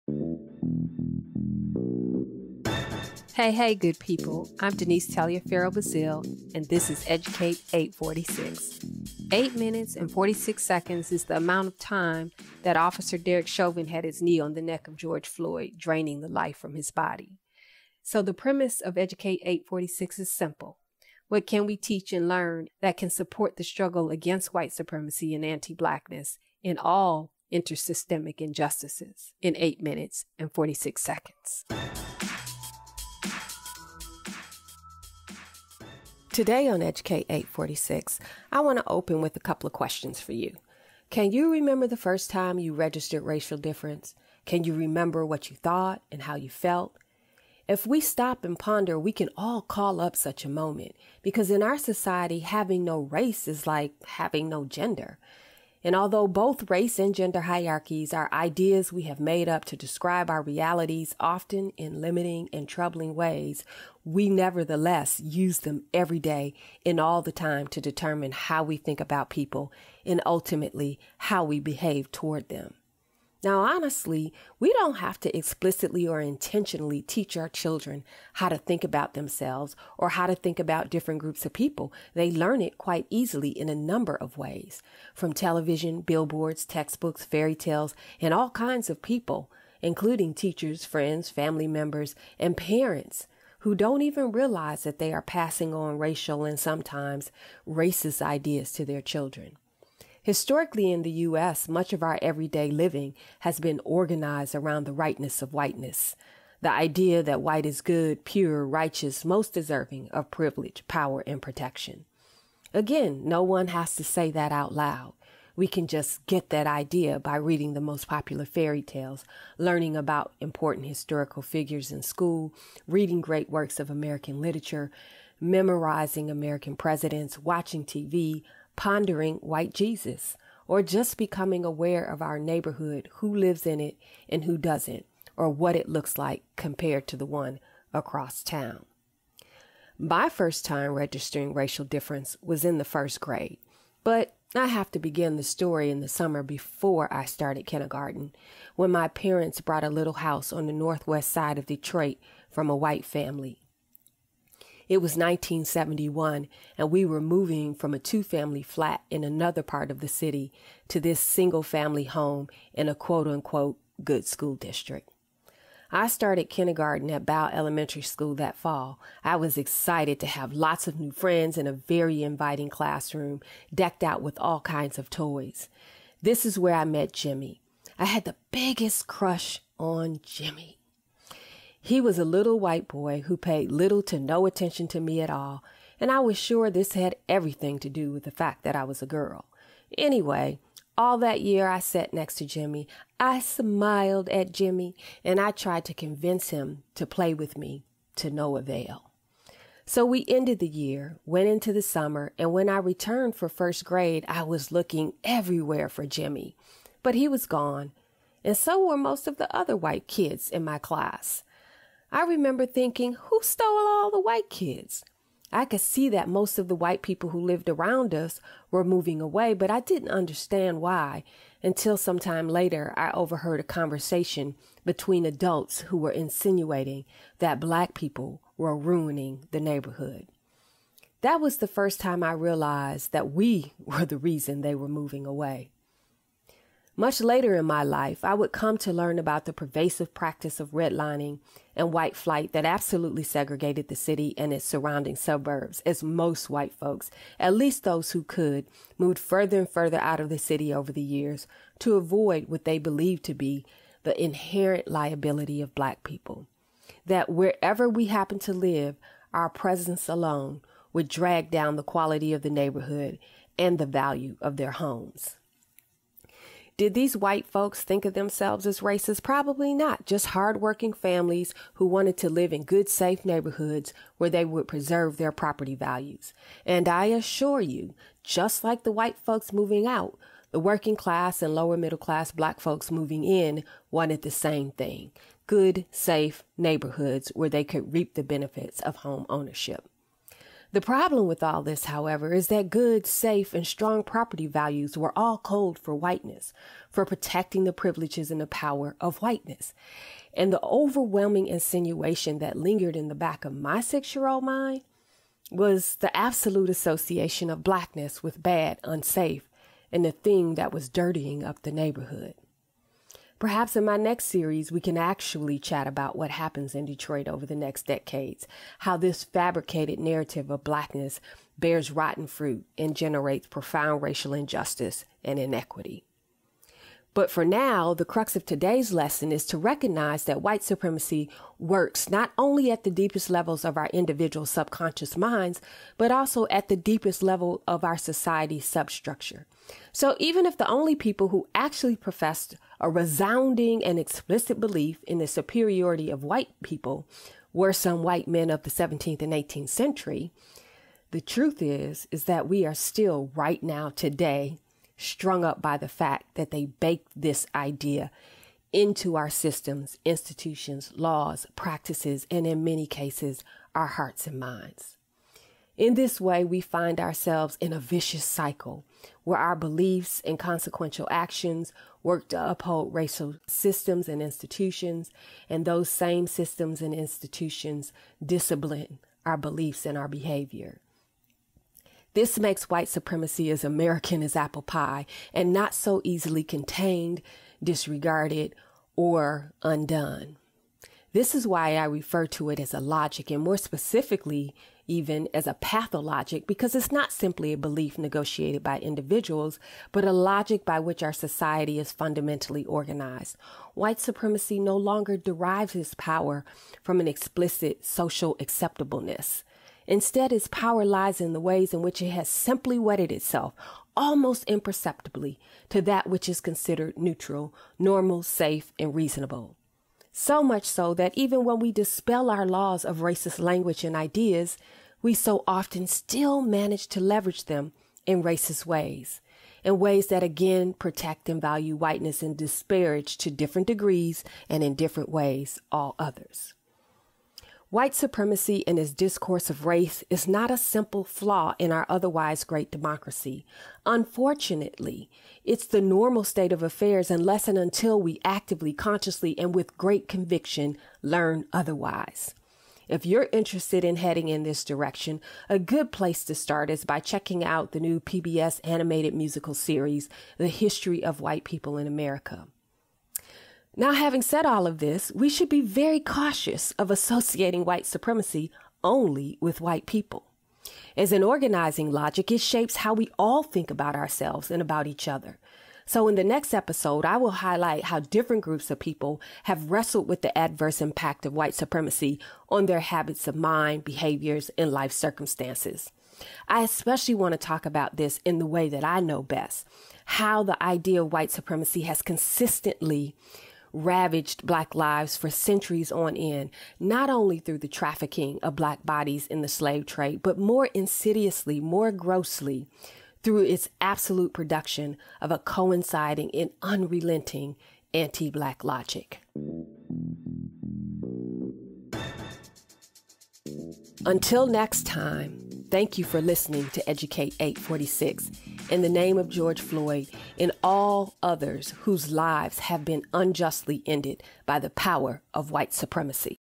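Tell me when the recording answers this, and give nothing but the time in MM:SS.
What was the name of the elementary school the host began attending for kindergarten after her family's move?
02:47.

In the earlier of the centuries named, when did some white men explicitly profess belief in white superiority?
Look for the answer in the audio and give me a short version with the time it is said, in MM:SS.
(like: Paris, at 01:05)
17th century, at 05:48.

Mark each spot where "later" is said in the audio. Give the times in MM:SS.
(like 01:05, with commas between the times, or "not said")
03:42, 03:57.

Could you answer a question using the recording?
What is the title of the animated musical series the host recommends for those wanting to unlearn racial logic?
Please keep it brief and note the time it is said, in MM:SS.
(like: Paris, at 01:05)
The History of White People in America, at 07:40.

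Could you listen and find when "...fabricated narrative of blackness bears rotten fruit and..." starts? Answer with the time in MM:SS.
05:19.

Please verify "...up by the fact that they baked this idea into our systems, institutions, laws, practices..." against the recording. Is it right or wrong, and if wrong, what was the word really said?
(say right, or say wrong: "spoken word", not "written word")
right.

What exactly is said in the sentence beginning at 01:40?
Historically, in the U.S., much of our everyday living has been organized around the rightness of whiteness.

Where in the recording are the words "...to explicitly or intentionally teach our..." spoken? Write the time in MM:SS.
01:15.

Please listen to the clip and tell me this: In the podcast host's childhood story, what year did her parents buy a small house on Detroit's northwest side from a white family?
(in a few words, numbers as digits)
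1971.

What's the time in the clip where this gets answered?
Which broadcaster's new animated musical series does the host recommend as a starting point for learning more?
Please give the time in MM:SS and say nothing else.
07:38.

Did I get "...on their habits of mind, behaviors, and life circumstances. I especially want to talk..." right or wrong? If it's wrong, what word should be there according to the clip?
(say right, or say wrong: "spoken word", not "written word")
right.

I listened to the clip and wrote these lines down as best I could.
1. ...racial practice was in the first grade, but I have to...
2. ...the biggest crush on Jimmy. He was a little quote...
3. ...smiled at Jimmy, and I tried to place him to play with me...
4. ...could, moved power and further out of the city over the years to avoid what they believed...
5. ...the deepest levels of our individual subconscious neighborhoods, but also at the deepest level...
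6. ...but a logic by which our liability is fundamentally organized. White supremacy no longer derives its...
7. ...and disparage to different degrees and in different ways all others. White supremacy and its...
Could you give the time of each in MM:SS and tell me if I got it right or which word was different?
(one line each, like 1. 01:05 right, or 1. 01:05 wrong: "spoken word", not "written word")
1. 02:21 wrong: "difference", not "practice"
2. 02:58 wrong: "white", not "quote"
3. 03:13 wrong: "convince", not "place"
4. 04:08 wrong: "further", not "power"
5. 05:32 wrong: "minds", not "neighborhoods"
6. 06:39 wrong: "society", not "liability"
7. 07:12 right.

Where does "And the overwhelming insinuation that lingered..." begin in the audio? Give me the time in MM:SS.
05:00.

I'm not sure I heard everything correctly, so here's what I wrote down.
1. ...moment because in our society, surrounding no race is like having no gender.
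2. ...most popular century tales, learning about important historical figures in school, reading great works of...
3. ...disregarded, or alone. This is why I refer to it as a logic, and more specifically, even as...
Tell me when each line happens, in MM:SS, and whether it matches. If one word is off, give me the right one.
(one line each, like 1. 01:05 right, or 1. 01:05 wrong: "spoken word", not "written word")
1. 00:50 wrong: "having", not "surrounding"
2. 01:57 wrong: "fairy", not "century"
3. 06:27 wrong: "undone", not "alone".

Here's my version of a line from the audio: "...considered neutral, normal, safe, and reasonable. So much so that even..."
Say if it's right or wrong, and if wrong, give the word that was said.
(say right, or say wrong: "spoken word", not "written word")
right.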